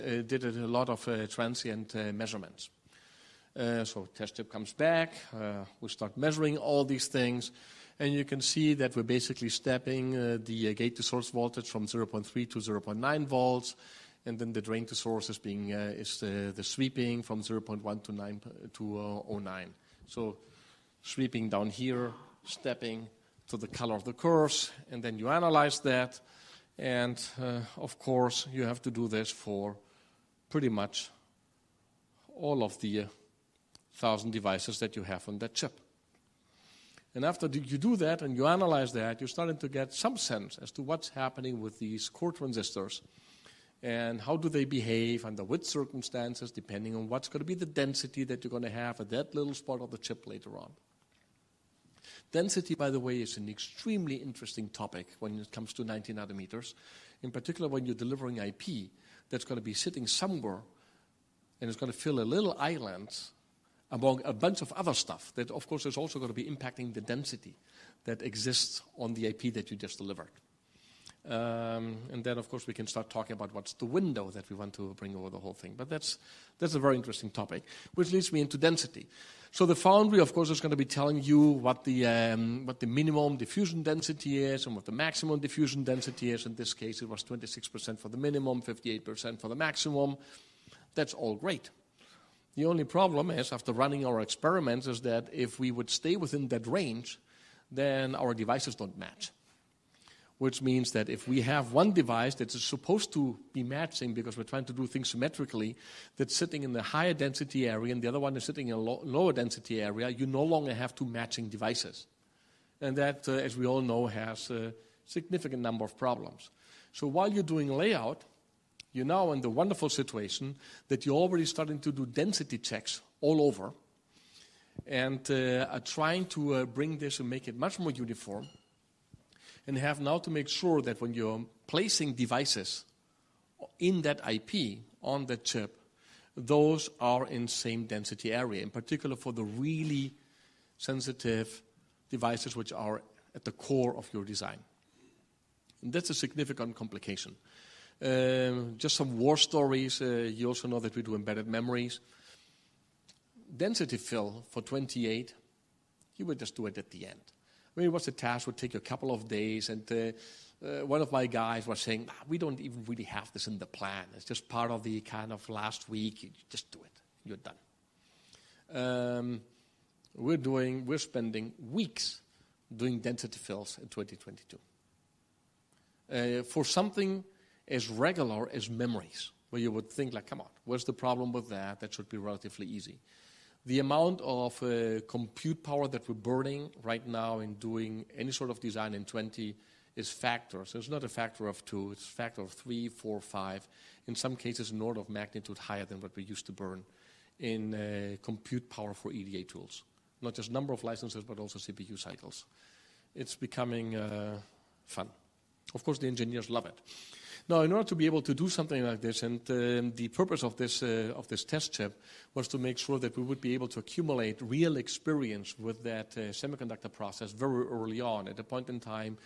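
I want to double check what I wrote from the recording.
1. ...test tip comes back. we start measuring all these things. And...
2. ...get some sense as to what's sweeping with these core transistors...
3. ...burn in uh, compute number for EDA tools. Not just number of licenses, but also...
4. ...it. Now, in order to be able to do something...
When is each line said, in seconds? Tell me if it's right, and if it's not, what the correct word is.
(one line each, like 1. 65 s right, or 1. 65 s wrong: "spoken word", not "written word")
1. 4 s right
2. 39 s wrong: "happening", not "sweeping"
3. 196 s wrong: "power", not "number"
4. 206 s right.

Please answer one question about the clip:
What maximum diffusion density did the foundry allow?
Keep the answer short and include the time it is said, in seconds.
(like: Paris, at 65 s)
58%, at 88 s.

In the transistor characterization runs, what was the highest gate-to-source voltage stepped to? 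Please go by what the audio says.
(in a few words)
0.9 volts.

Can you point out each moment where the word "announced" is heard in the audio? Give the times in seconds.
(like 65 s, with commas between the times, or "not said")
not said.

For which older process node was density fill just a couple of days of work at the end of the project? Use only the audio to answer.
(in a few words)
28.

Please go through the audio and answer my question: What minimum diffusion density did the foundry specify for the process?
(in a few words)
26%.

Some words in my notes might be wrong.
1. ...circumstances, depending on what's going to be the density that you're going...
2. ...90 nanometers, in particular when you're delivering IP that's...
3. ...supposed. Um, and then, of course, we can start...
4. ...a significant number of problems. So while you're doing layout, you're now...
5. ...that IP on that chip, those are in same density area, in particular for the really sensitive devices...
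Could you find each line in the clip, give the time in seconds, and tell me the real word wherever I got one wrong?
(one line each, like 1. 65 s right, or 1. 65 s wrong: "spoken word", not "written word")
1. 45 s right
2. 55 s right
3. 69 s wrong: "delivered", not "supposed"
4. 114 s right
5. 134 s right.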